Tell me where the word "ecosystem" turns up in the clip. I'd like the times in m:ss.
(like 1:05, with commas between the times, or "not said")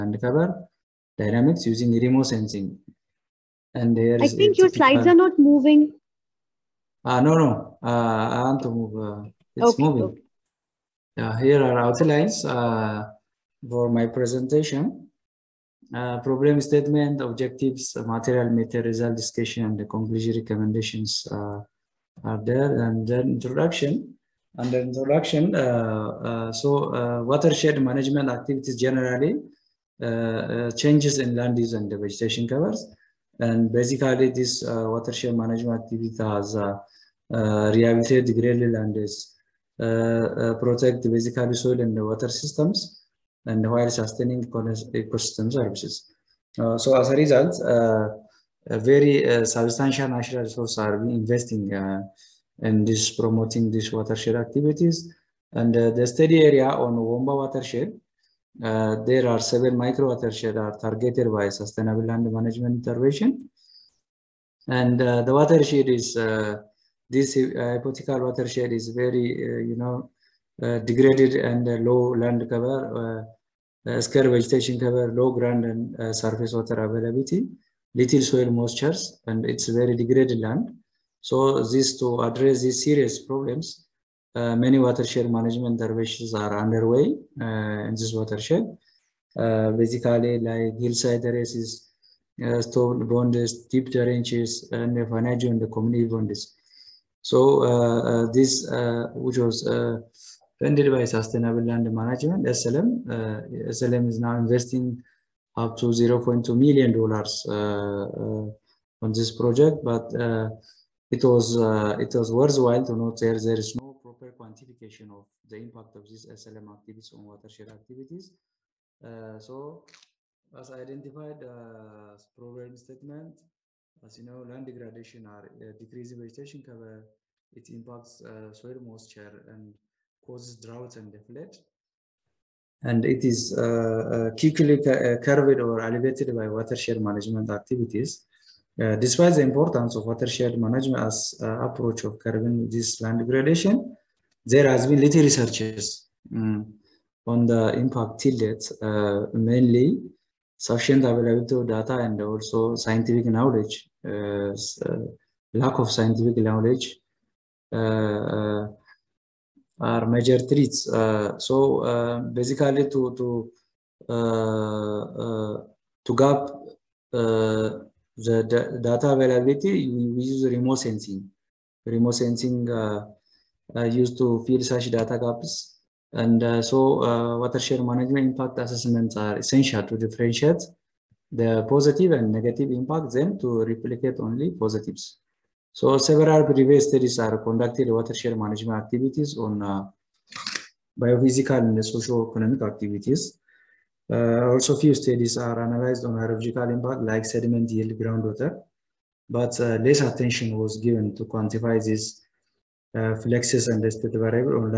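0:44.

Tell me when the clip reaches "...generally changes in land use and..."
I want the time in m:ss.
0:28.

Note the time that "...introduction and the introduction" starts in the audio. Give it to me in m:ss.
0:23.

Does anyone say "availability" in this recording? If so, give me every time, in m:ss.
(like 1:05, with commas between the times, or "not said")
1:16, 2:31, 2:49.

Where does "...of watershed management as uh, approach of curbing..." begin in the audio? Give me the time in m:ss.
2:19.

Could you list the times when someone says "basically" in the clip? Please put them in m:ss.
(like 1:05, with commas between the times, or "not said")
0:33, 0:41, 1:29, 2:42.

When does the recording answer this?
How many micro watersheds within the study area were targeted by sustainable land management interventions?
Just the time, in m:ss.
0:59.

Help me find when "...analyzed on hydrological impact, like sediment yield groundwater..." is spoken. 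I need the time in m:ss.
3:15.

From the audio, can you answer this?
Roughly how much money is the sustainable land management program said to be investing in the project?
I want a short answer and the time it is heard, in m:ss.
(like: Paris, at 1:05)
$0.2 million, at 1:45.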